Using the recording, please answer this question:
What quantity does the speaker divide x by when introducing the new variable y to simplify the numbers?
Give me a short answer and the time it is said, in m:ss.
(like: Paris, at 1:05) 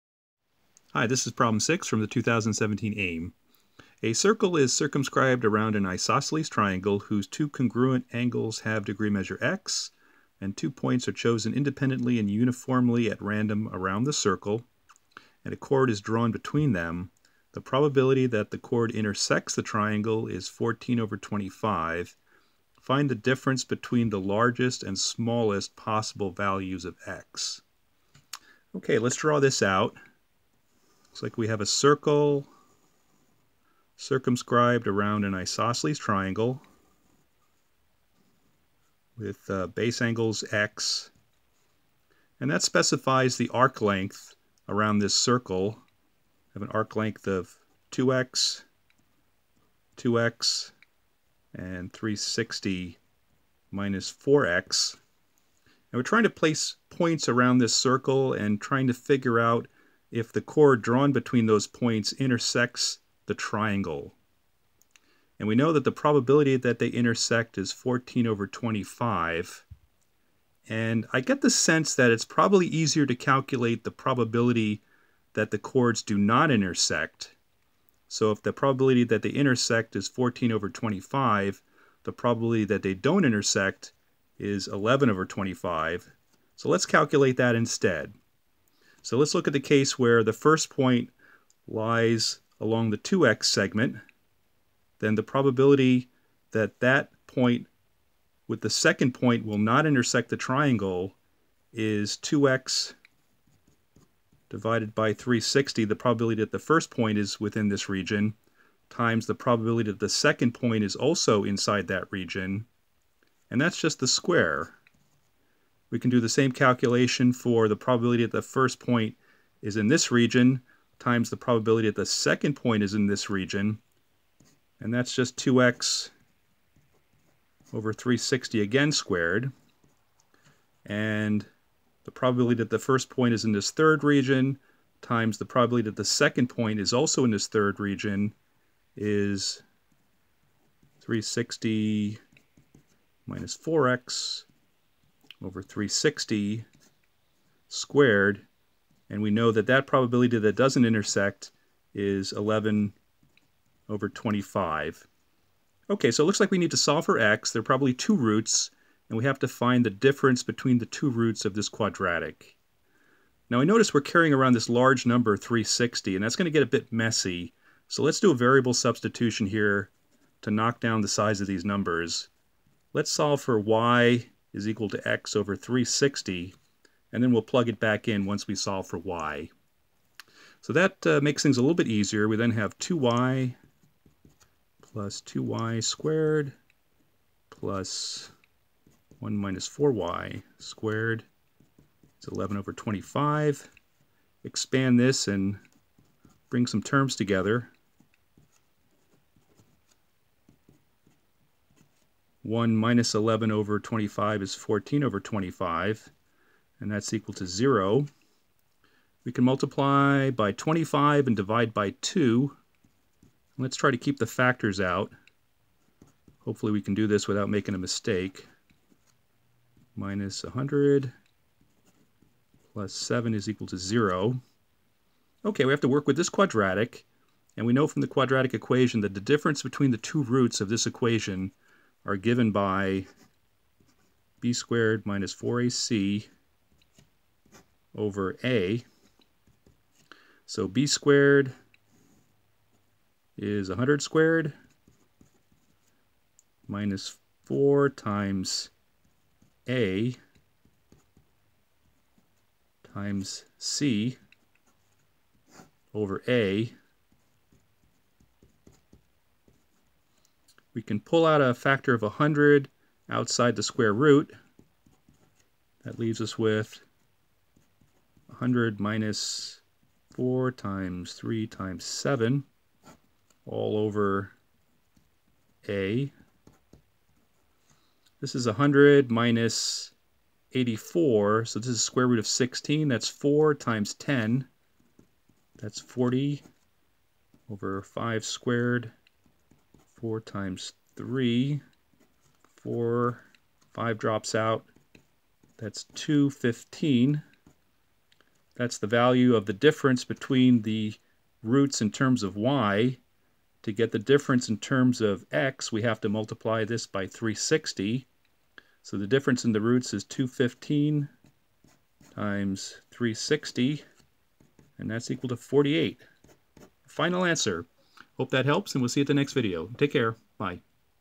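360, at 2:55.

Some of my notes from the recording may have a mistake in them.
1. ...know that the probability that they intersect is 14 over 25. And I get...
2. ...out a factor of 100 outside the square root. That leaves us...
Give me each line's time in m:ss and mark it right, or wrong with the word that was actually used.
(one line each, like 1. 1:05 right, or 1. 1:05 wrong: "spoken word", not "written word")
1. 1:05 right
2. 4:21 right.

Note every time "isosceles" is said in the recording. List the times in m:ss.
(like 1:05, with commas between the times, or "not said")
0:05, 0:35.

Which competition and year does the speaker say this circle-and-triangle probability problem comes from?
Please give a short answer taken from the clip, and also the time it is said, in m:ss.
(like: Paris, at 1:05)
2017 AIME, at 0:02.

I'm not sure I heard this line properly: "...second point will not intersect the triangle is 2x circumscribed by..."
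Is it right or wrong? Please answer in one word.
wrong.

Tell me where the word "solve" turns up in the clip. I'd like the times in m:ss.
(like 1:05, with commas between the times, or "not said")
2:36, 2:53, 2:58.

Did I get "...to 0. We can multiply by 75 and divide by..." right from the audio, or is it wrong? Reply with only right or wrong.
wrong.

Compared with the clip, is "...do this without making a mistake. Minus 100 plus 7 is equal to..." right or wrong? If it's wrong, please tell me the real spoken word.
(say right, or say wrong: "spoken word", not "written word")
right.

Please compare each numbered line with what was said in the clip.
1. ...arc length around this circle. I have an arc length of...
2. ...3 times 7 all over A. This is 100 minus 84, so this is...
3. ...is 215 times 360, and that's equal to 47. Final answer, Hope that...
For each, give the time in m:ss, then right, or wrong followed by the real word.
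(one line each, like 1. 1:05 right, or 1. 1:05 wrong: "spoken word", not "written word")
1. 0:43 right
2. 4:31 right
3. 5:09 wrong: "48", not "47".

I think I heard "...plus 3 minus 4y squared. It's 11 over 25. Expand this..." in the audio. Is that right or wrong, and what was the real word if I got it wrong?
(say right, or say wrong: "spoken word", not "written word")
wrong: "1", not "3".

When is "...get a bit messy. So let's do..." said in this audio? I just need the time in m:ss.
2:46.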